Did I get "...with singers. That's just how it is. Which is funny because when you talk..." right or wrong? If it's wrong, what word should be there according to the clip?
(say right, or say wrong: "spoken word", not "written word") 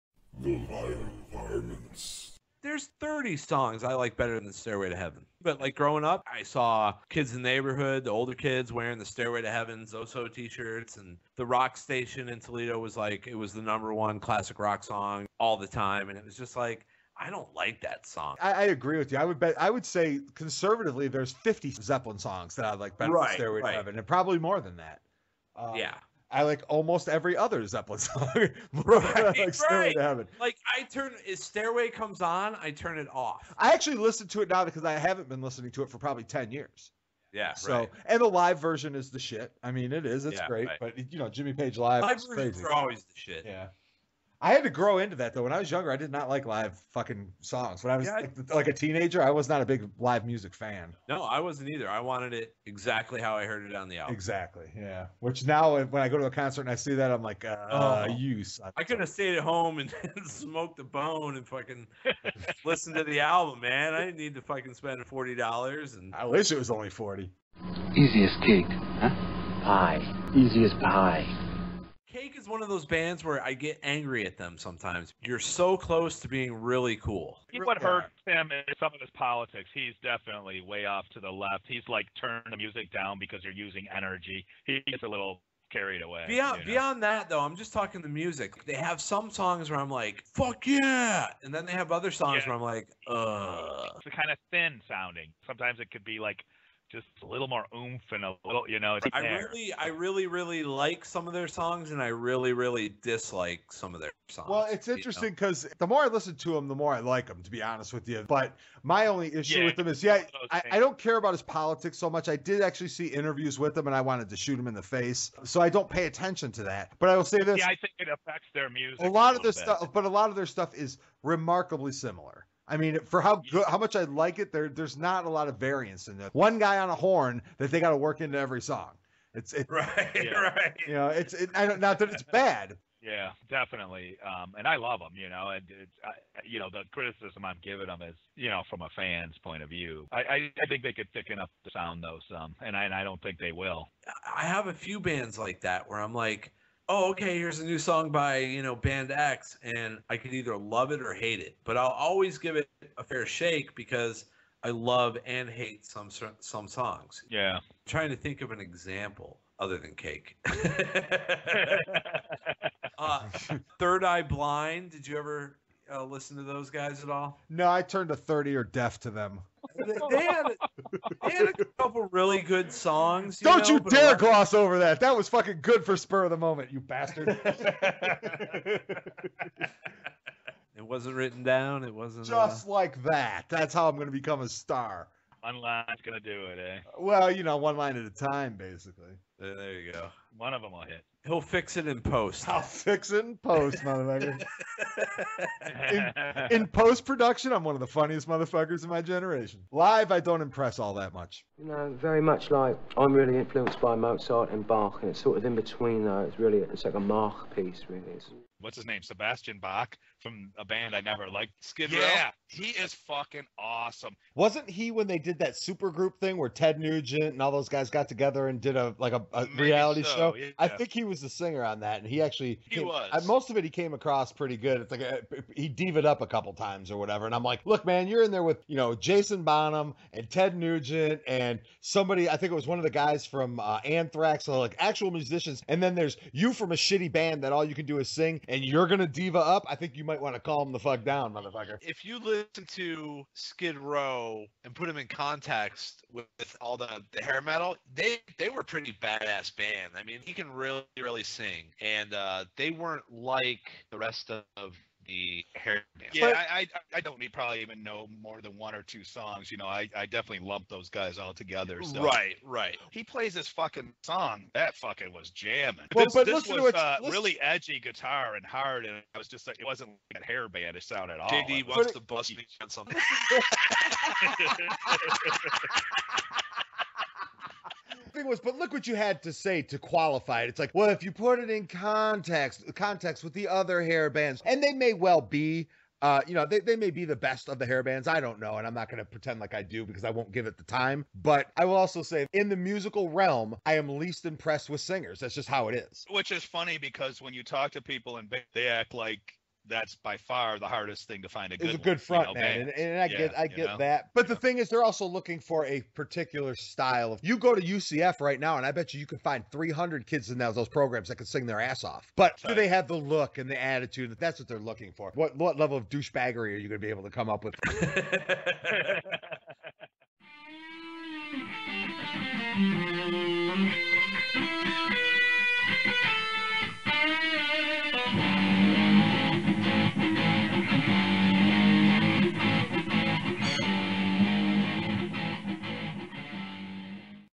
right.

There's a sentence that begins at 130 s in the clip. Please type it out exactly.
You know, it's it, I don't not that it's bad.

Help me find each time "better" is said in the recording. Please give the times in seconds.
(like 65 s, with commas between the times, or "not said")
4 s, 22 s.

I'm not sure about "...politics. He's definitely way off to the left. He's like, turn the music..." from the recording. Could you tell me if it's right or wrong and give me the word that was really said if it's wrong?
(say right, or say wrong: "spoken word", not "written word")
right.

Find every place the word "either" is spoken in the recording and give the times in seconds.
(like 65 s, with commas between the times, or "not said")
51 s, 150 s.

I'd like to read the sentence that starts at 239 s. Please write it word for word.
I think you might want to calm the fuck down, motherfucker.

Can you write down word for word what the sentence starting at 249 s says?
I mean mean, he can really, really sing, and uh, they weren't like the rest of the hair band.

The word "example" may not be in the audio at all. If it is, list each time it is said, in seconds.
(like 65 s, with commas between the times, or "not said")
158 s.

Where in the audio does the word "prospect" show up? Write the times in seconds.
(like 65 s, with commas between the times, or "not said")
not said.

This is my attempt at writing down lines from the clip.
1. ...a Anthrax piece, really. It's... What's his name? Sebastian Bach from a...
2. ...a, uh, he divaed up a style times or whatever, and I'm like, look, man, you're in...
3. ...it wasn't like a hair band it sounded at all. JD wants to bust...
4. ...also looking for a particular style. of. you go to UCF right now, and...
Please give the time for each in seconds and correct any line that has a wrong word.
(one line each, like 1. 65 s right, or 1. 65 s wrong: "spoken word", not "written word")
1. 206 s wrong: "Mach", not "Anthrax"
2. 225 s wrong: "couple", not "style"
3. 269 s right
4. 304 s right.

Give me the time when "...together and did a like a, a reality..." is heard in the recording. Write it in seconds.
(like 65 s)
218 s.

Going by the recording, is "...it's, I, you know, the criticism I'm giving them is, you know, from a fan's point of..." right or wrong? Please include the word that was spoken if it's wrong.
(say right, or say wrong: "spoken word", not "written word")
right.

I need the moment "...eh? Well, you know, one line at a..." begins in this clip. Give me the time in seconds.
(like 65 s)
186 s.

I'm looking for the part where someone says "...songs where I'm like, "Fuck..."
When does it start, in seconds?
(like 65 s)
89 s.